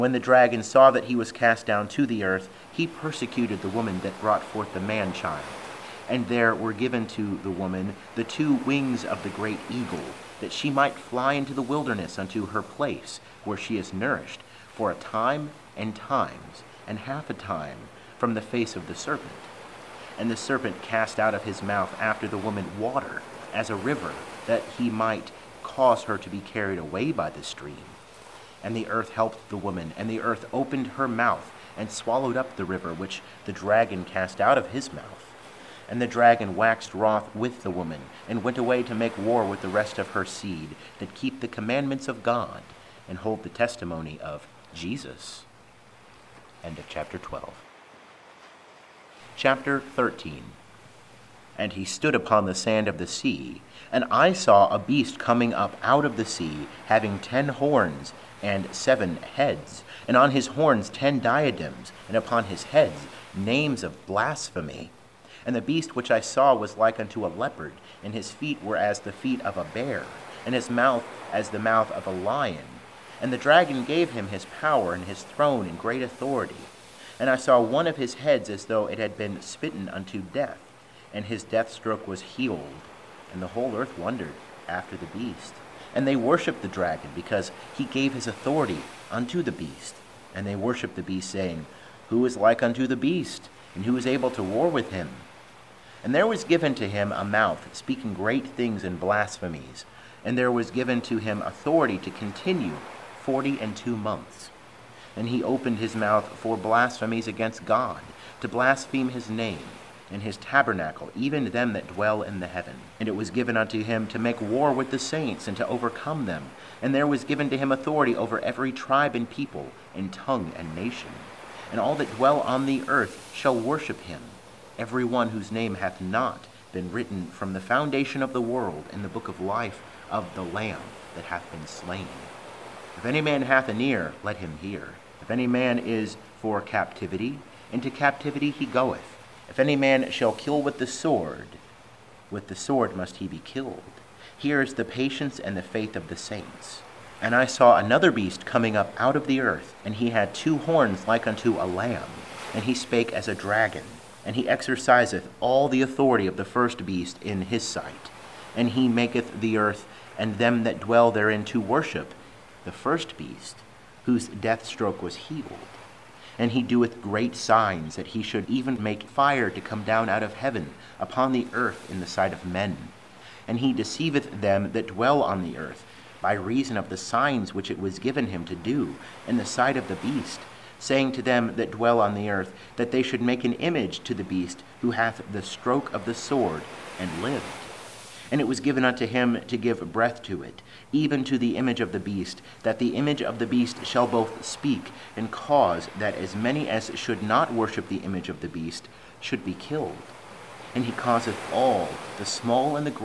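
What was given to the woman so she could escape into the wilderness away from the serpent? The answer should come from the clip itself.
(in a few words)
two wings of the great eagle.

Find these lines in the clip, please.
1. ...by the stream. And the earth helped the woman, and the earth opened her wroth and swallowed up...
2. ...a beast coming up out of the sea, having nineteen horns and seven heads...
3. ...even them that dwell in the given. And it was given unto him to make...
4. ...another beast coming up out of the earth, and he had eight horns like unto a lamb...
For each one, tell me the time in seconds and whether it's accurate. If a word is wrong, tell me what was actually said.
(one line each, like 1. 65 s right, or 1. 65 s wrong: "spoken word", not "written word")
1. 27 s wrong: "mouth", not "wroth"
2. 54 s wrong: "ten", not "nineteen"
3. 111 s wrong: "heaven", not "given"
4. 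147 s wrong: "two", not "eight".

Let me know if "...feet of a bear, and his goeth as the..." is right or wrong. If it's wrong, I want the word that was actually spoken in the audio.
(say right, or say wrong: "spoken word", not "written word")
wrong: "mouth", not "goeth".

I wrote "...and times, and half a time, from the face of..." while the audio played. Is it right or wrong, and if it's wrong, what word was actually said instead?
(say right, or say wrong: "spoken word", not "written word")
right.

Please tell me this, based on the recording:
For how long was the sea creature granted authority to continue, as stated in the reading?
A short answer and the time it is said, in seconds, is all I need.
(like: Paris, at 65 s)
42 months, at 103 s.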